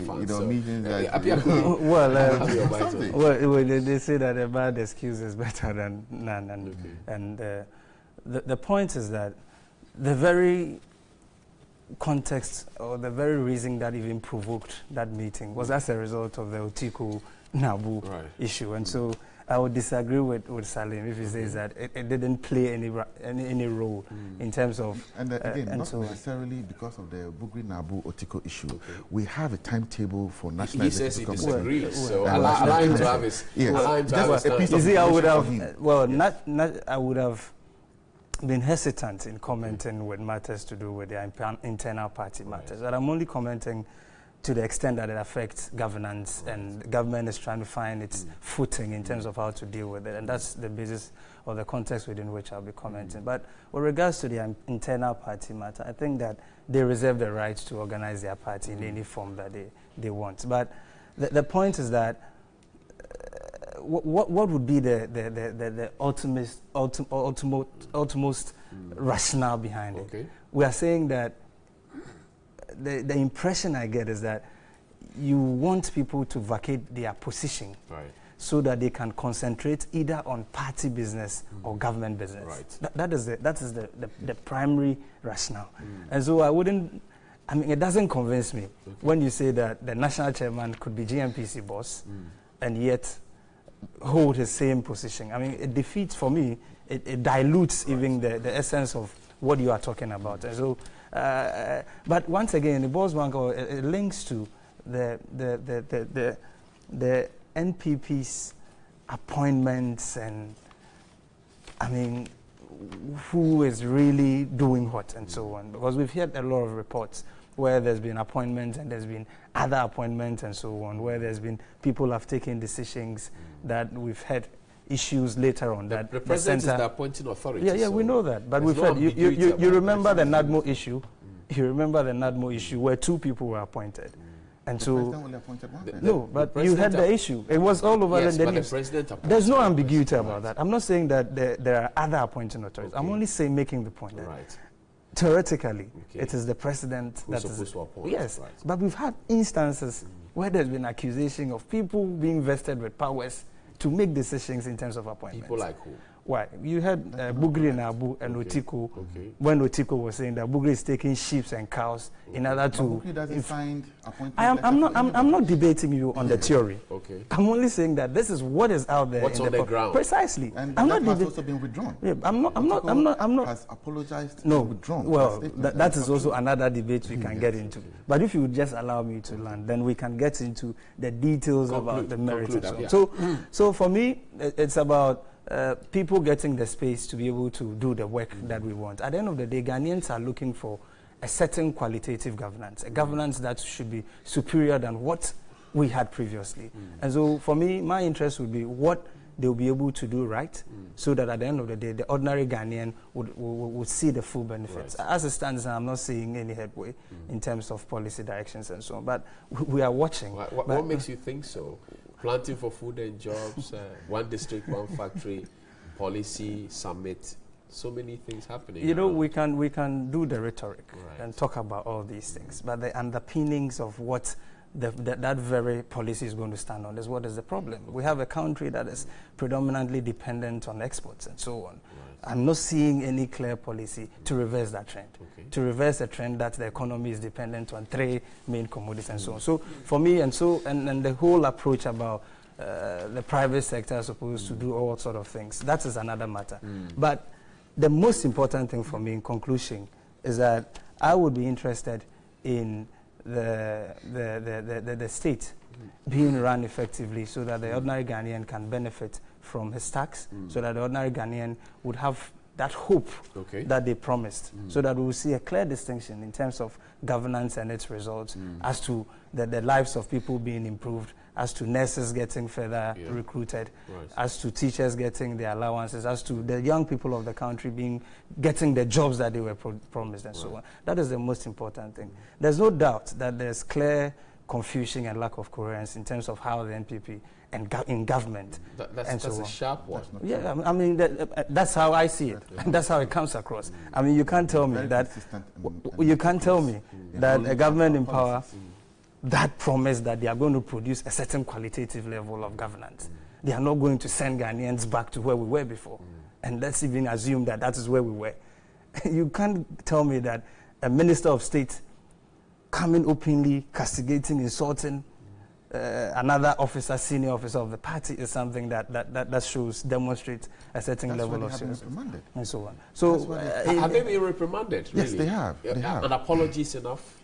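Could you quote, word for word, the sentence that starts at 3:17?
And so for me, my interest would be what they'll be able to do right mm.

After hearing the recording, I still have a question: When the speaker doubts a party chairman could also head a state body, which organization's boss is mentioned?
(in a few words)
GNPC.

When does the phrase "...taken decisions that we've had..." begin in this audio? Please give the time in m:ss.
2:02.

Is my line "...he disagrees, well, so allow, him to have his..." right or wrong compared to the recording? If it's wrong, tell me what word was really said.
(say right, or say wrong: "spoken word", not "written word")
right.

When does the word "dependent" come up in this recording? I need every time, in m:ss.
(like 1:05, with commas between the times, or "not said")
3:50, 3:57.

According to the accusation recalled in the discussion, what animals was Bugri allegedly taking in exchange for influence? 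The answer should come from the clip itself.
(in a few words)
sheep and cows.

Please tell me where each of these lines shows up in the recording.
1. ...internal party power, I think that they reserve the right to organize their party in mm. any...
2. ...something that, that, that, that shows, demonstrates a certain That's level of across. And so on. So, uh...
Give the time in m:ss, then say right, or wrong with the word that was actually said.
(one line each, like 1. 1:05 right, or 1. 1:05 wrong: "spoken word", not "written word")
1. 0:54 wrong: "matter", not "power"
2. 5:18 wrong: "seriousness", not "across".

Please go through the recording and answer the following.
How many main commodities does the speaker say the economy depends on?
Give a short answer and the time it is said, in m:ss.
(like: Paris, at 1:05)
3, at 3:57.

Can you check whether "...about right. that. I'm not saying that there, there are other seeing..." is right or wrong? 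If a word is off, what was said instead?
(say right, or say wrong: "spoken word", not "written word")
wrong: "appointing", not "seeing".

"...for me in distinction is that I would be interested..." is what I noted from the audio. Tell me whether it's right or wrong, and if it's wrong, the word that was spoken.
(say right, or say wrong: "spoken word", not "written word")
wrong: "conclusion", not "distinction".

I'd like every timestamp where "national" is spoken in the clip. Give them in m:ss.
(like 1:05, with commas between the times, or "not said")
0:30, 1:29.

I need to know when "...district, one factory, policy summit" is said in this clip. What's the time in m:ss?
3:34.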